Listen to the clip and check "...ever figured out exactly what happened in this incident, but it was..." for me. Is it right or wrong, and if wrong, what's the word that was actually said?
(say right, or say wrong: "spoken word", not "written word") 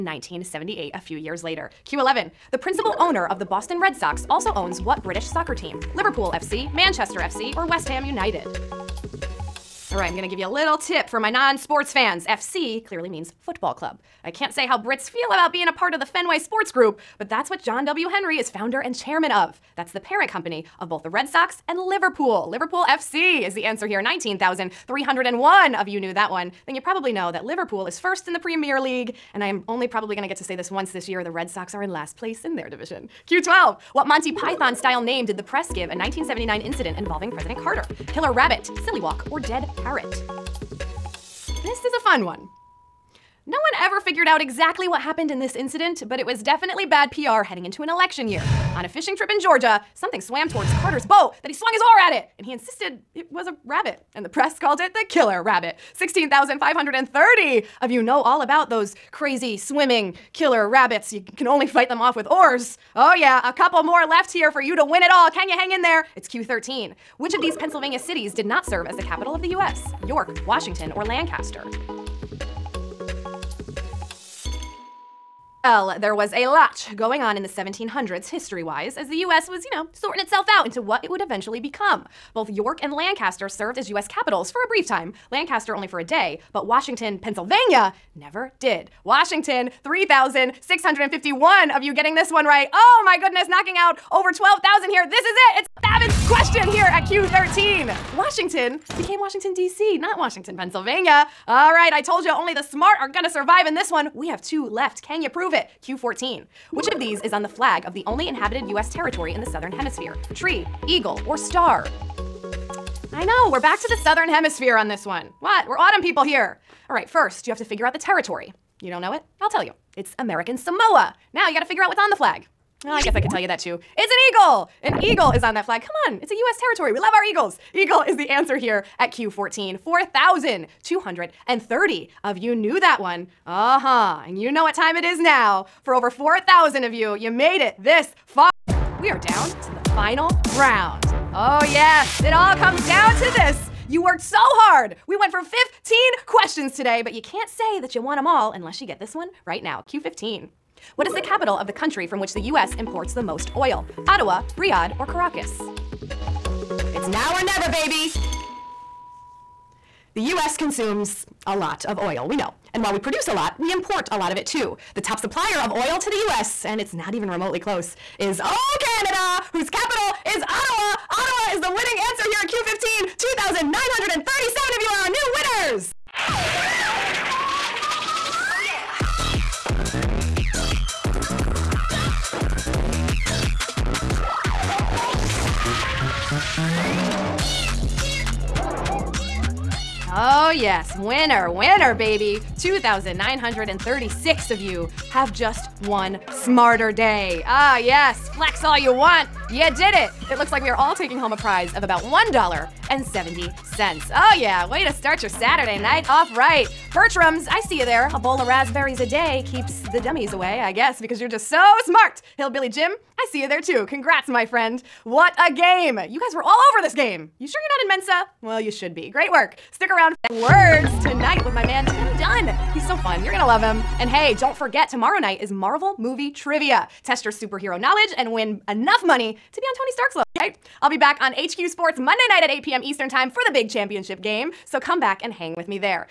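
right.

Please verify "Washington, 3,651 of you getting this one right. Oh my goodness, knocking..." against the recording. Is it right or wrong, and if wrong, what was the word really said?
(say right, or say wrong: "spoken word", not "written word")
right.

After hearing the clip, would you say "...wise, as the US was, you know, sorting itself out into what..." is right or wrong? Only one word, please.
right.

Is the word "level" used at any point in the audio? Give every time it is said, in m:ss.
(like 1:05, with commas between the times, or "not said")
3:50.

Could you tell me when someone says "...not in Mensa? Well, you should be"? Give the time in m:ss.
3:37.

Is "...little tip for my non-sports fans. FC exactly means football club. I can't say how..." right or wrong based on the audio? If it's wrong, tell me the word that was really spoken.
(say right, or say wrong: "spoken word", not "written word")
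wrong: "clearly", not "exactly".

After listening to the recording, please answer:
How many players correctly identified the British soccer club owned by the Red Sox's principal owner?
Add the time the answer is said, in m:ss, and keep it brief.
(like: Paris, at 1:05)
19,301, at 0:24.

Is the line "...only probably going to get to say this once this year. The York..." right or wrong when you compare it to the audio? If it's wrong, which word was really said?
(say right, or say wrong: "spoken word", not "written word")
wrong: "Red", not "York".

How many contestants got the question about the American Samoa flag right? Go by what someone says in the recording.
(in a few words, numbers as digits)
4,230.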